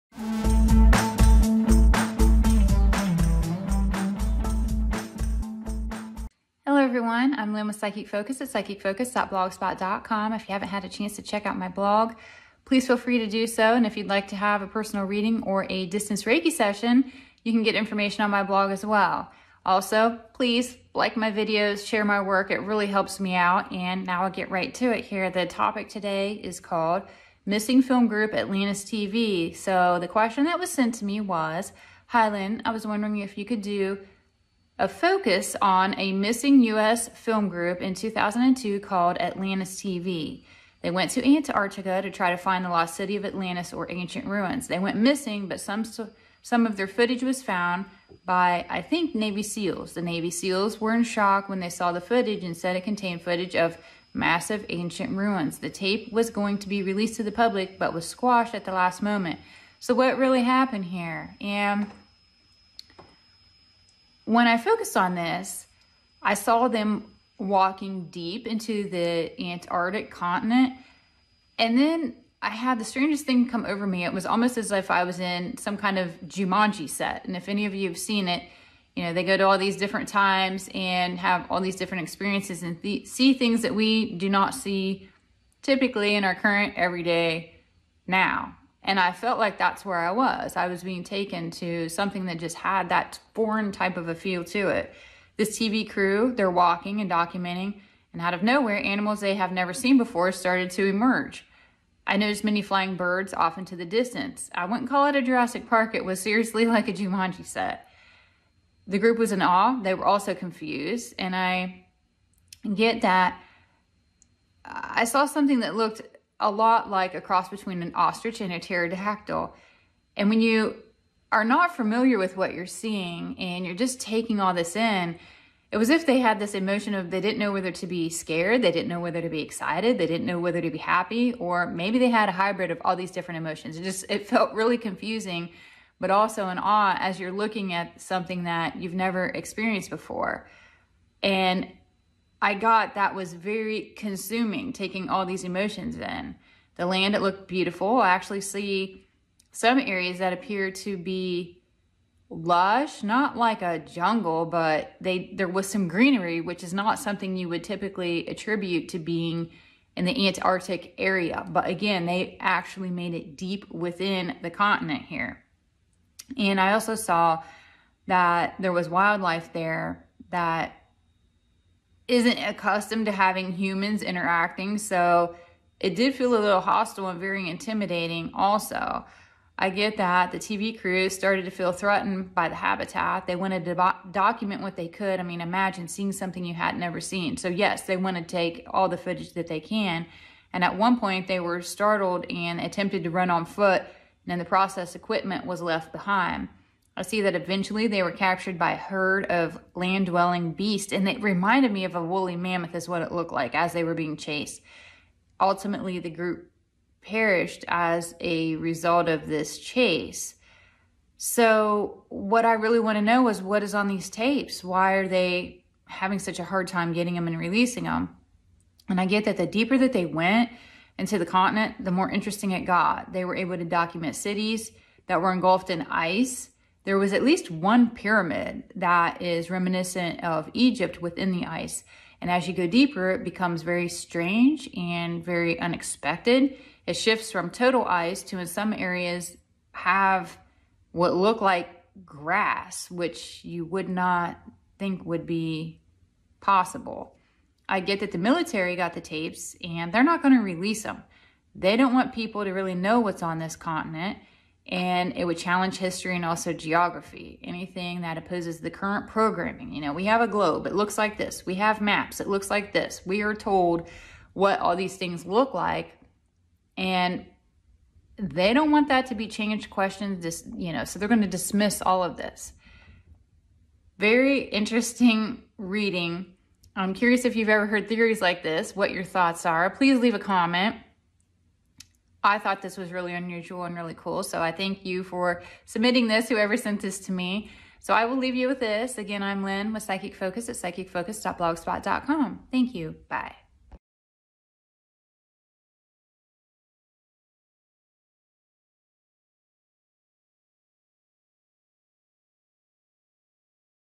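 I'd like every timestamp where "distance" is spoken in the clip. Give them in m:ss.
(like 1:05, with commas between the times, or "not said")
0:15, 1:43.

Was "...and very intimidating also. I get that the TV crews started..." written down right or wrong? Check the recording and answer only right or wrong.
right.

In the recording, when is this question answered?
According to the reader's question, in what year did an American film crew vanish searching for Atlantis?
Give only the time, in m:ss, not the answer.
0:37.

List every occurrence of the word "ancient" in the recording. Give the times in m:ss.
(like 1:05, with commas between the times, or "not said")
0:43, 0:54.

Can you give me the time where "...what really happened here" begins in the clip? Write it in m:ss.
0:59.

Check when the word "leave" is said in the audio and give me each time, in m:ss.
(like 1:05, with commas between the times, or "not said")
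4:39, 4:48.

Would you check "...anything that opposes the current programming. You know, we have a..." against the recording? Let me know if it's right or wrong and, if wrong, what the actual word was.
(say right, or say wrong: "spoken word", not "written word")
right.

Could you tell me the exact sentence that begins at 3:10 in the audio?
And at one point they were startled and attempted to run on foot and in the process equipment was left behind.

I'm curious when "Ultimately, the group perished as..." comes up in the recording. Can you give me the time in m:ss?
3:25.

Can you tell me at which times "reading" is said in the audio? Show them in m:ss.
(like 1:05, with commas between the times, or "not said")
0:15, 4:35.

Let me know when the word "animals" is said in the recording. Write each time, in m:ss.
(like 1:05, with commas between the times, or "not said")
1:38.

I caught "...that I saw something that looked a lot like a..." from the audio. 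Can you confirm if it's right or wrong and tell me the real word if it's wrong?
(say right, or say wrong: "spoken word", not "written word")
right.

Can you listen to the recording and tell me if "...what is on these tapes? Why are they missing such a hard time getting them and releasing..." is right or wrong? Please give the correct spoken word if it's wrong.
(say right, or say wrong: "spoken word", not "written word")
wrong: "having", not "missing".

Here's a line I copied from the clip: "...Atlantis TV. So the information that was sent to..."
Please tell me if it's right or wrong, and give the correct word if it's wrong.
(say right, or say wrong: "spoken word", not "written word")
wrong: "question", not "information".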